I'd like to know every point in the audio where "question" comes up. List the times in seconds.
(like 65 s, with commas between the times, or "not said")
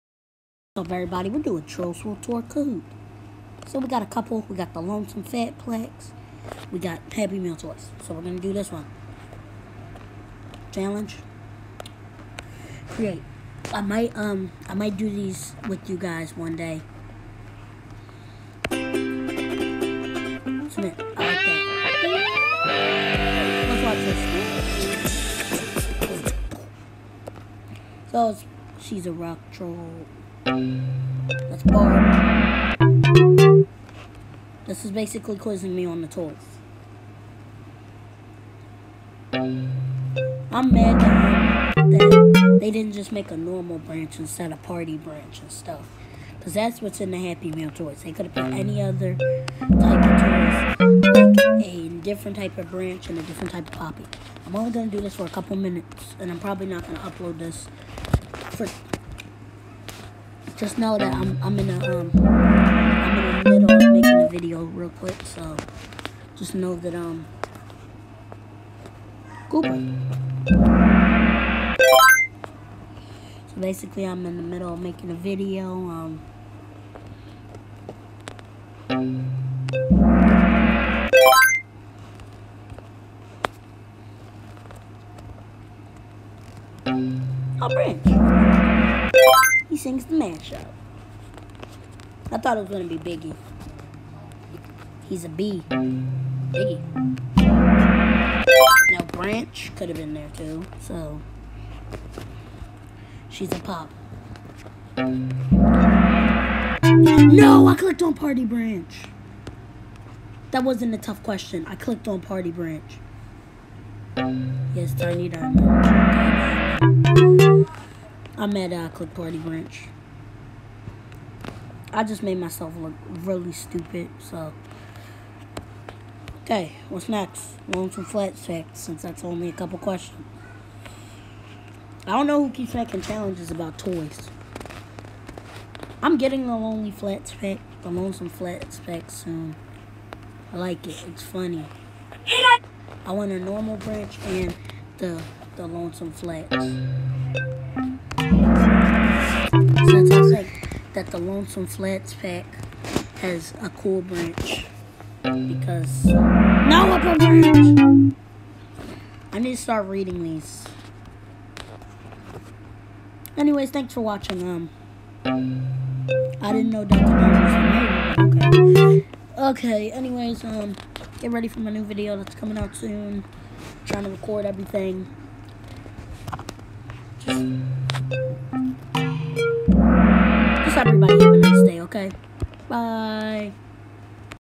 111 s, 129 s.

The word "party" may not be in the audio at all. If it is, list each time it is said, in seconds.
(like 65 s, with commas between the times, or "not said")
44 s, 108 s, 112 s, 119 s.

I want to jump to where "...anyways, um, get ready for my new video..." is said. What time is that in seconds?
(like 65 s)
169 s.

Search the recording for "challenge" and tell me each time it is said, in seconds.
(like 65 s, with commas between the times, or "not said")
10 s, 133 s.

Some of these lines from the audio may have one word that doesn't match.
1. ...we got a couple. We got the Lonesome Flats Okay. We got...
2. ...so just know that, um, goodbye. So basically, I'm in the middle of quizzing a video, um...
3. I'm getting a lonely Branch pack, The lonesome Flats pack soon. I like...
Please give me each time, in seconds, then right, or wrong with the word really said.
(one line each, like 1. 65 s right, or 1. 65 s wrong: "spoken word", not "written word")
1. 3 s wrong: "Pack", not "Okay"
2. 65 s wrong: "making", not "quizzing"
3. 136 s wrong: "Flats", not "Branch".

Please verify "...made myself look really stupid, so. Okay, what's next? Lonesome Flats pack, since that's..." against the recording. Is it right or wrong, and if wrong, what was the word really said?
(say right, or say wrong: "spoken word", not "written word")
right.